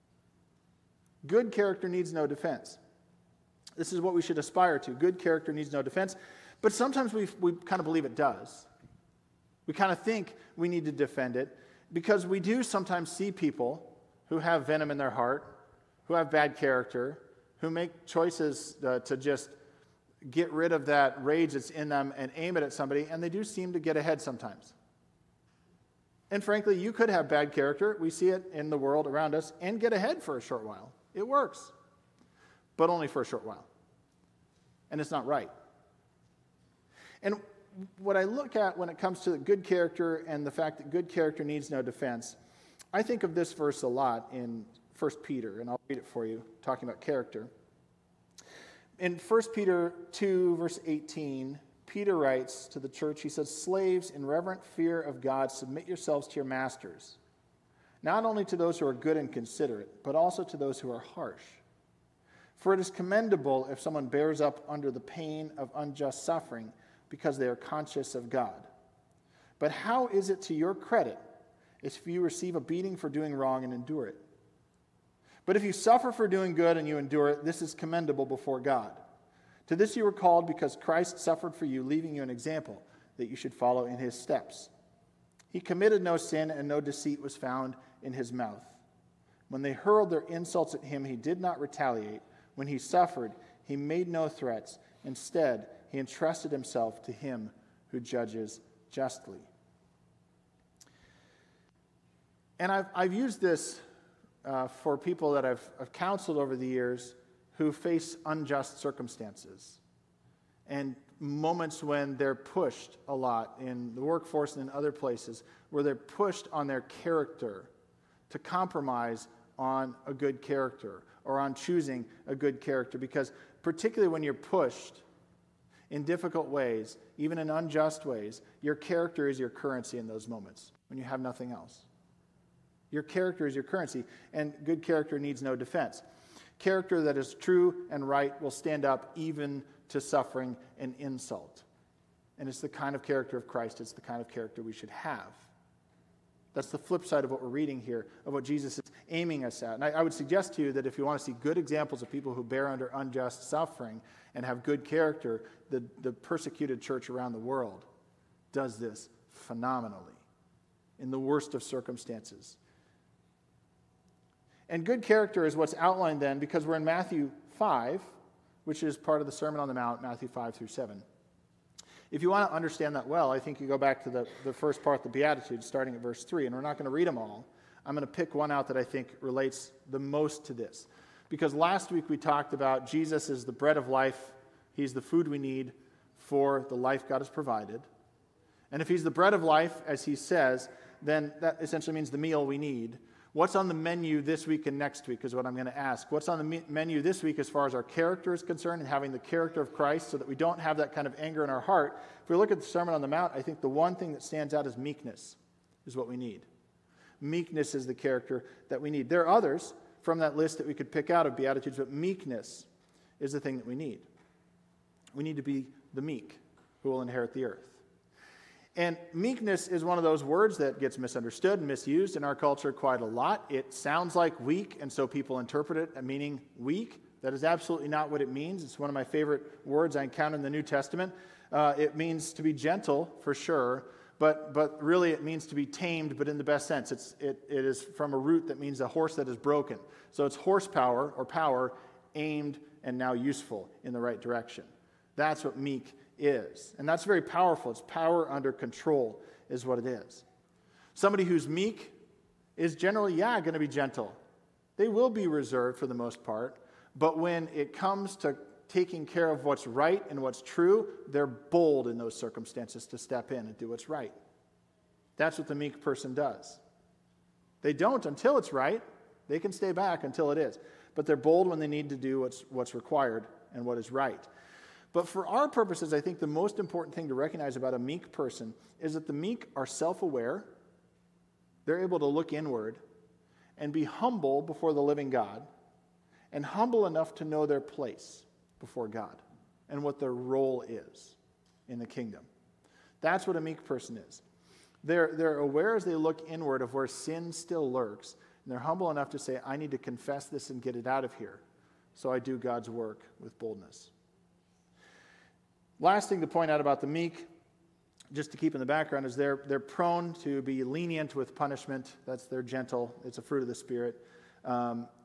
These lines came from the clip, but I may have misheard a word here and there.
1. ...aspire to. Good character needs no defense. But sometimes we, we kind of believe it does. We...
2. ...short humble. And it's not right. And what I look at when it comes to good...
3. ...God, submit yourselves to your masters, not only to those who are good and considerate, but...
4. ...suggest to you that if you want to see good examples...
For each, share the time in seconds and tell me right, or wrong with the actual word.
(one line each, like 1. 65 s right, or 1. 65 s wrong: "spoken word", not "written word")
1. 4 s right
2. 33 s wrong: "while", not "humble"
3. 55 s right
4. 150 s right.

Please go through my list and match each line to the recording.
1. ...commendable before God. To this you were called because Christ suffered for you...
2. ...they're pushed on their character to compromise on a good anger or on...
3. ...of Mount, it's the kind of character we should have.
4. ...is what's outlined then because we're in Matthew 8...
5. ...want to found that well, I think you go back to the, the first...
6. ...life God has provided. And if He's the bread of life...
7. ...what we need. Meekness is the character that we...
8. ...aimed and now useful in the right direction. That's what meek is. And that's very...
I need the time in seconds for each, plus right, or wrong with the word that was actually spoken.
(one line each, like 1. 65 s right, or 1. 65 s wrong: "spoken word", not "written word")
1. 77 s right
2. 115 s wrong: "character", not "anger"
3. 143 s wrong: "Christ", not "Mount"
4. 165 s wrong: "5", not "8"
5. 172 s wrong: "understand", not "found"
6. 186 s right
7. 205 s right
8. 242 s right.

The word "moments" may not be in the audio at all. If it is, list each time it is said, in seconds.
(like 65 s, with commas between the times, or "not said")
111 s, 130 s.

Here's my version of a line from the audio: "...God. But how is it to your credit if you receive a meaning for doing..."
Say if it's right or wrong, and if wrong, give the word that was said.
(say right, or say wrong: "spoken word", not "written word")
wrong: "beating", not "meaning".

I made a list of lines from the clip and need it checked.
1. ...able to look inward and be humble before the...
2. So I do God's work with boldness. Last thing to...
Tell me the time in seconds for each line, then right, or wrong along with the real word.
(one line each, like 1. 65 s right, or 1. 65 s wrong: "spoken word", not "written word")
1. 281 s right
2. 301 s right.